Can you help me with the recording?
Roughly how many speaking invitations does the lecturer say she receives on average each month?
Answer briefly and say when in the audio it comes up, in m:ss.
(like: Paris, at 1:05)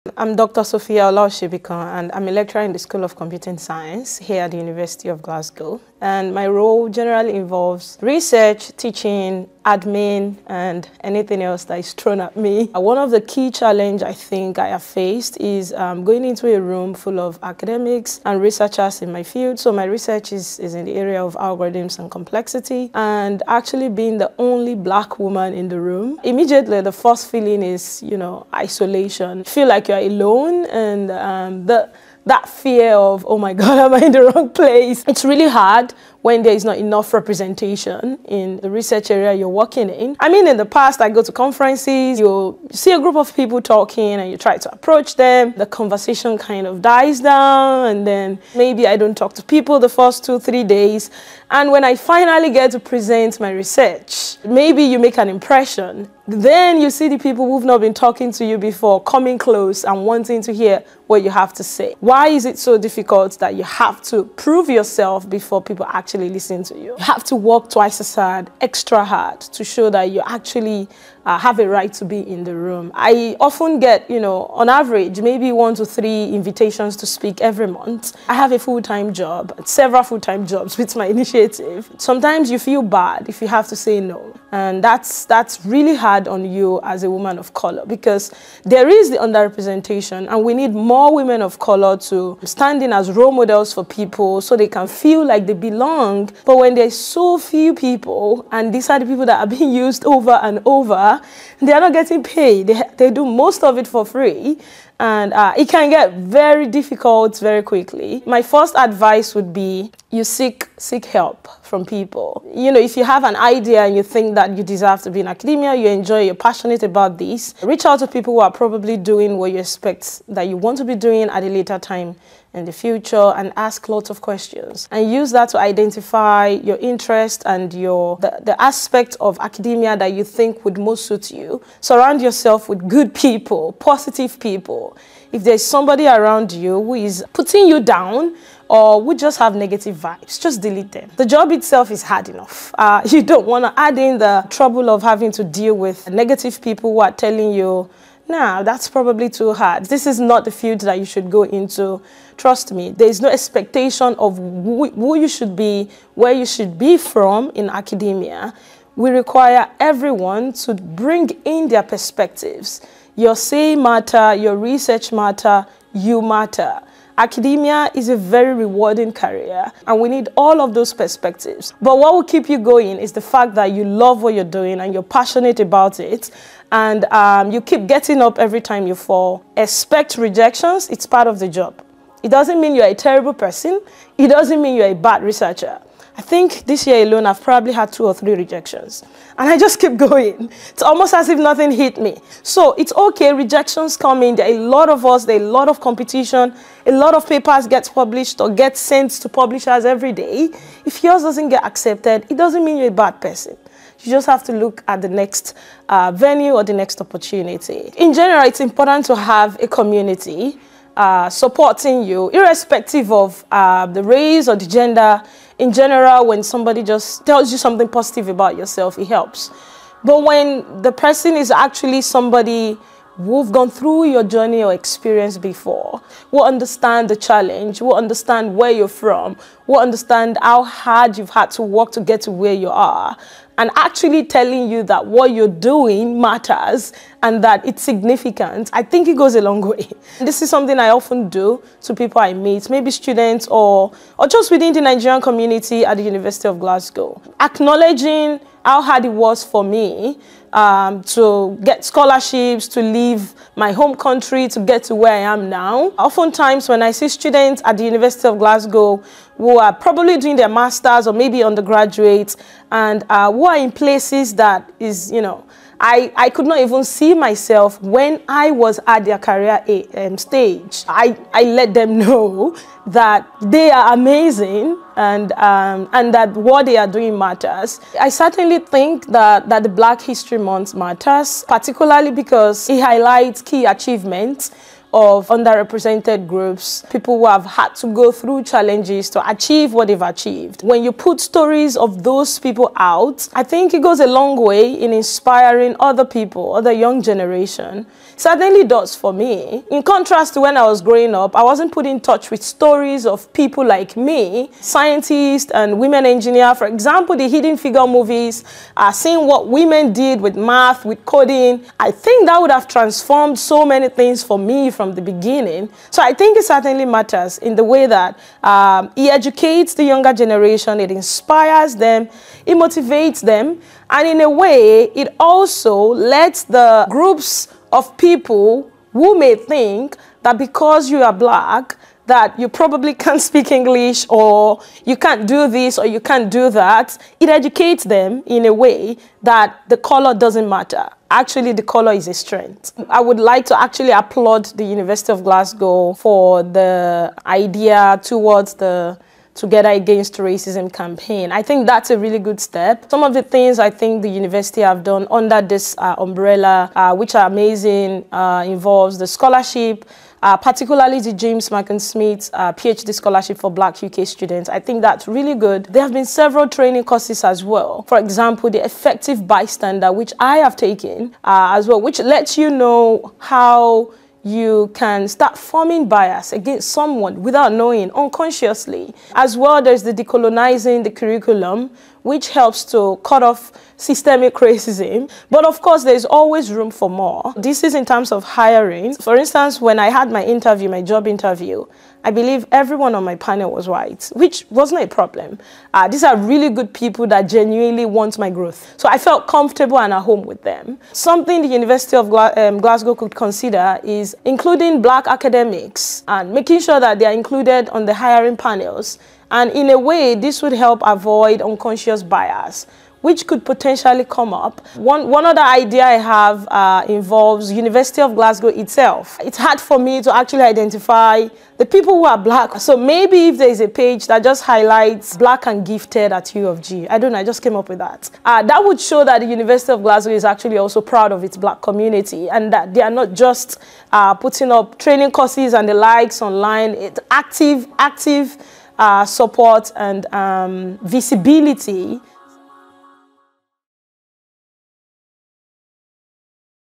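1 to 3, at 1:15.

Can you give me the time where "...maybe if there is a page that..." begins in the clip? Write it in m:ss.
7:02.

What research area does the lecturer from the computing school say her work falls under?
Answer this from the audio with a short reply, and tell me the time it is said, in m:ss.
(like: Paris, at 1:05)
algorithms and complexity, at 0:21.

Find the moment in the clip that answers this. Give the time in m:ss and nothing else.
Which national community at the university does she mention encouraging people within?
4:04.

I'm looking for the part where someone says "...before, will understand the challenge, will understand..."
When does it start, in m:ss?
3:45.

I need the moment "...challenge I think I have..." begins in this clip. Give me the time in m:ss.
0:13.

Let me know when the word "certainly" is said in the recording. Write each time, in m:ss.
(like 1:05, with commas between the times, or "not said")
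4:38, 4:58, 5:16.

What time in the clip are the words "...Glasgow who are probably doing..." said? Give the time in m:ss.
4:18.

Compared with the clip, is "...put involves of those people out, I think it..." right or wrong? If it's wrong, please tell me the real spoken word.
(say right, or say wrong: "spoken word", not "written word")
wrong: "stories", not "involves".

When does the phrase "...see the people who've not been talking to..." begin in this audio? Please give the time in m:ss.
0:56.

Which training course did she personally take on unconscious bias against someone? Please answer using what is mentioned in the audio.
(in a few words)
effective bystander.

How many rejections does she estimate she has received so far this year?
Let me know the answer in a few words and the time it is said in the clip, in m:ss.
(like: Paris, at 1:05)
2 or 3, at 3:07.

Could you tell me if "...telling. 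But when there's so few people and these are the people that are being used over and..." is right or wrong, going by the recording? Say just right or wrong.
wrong.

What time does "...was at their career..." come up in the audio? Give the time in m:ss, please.
4:28.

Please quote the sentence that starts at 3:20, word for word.
If yours doesn't get accepted, it doesn't mean you're a bad person.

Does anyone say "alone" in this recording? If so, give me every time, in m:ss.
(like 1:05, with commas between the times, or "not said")
0:29, 3:07.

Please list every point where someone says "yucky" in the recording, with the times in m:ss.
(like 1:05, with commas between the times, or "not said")
not said.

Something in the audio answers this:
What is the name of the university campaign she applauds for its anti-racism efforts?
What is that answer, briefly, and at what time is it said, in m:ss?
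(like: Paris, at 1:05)
Together Against Racism, at 5:49.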